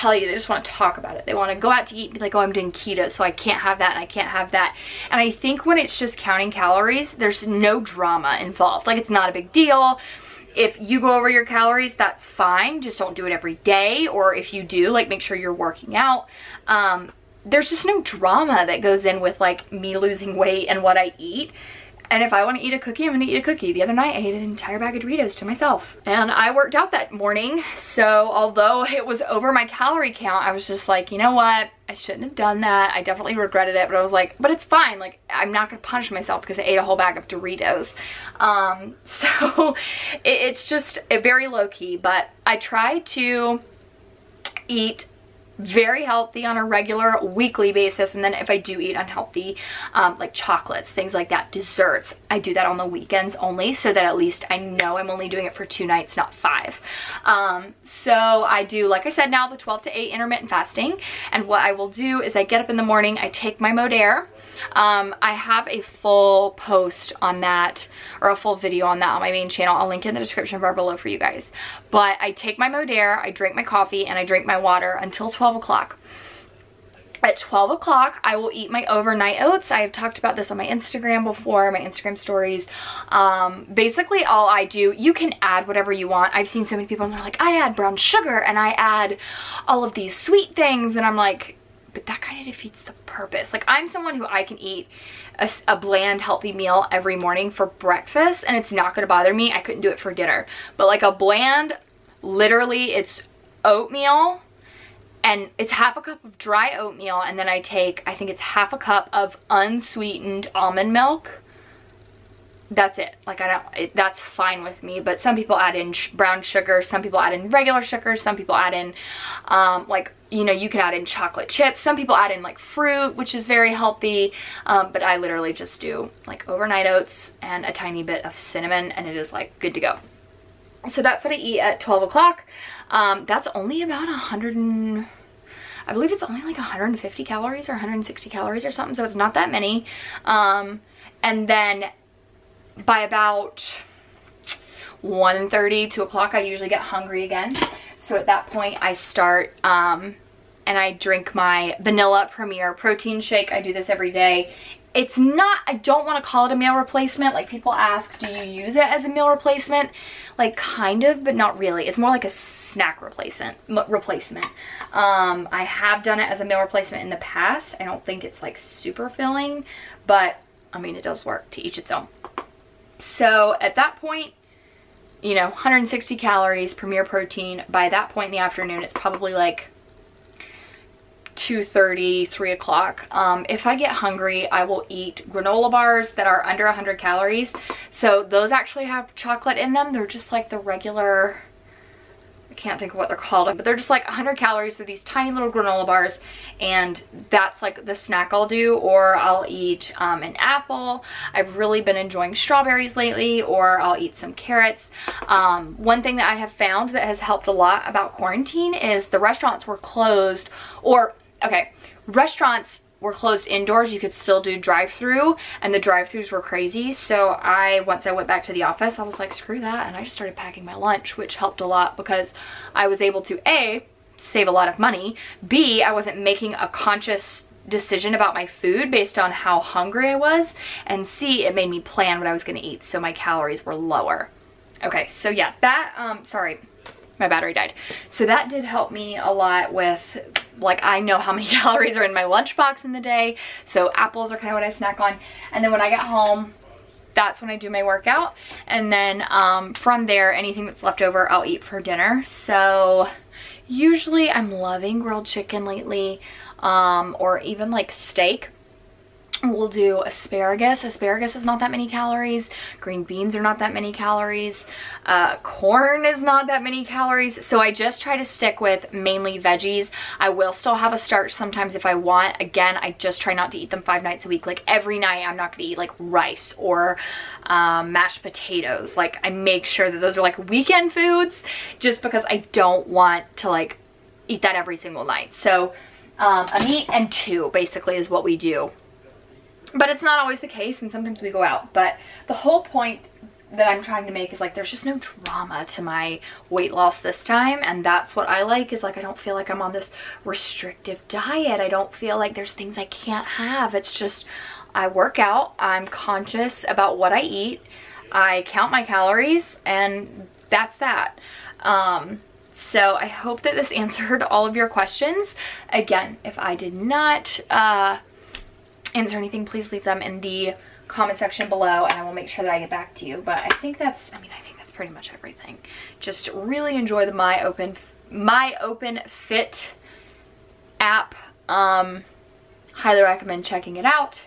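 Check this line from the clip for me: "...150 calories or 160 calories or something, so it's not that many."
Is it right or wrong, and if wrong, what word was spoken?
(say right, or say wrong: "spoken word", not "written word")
right.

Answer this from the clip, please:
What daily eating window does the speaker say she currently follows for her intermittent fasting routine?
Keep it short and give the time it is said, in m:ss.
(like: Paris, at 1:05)
12 to 8, at 0:59.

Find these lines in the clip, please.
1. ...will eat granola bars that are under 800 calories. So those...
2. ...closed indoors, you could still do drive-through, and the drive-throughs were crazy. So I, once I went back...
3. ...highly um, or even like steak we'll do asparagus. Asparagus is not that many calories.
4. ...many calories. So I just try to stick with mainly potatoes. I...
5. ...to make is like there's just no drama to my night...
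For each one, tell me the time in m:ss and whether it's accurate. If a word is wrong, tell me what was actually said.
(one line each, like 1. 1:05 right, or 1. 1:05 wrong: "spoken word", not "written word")
1. 3:04 wrong: "100", not "800"
2. 3:33 right
3. 4:15 wrong: "lately", not "highly"
4. 4:26 wrong: "veggies", not "potatoes"
5. 4:54 wrong: "weight", not "night".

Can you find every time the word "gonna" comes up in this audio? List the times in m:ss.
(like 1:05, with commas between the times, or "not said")
1:38, 3:52, 4:35.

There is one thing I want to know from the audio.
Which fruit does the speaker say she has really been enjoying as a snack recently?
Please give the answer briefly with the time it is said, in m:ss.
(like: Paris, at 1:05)
Strawberries, at 3:22.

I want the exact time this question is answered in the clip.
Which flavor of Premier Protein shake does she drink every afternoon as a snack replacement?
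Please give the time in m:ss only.
2:31.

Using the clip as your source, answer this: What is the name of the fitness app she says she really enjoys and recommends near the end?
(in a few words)
Openfit.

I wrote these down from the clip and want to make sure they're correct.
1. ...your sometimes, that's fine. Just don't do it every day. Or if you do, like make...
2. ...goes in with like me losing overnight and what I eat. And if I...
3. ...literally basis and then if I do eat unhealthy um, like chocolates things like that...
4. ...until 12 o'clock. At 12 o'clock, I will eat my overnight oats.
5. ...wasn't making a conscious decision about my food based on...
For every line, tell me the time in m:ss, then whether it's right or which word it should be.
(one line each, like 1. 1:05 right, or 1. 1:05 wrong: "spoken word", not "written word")
1. 0:11 wrong: "calories", not "sometimes"
2. 0:18 wrong: "weight", not "overnight"
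3. 0:47 wrong: "weekly", not "literally"
4. 1:14 right
5. 3:45 right.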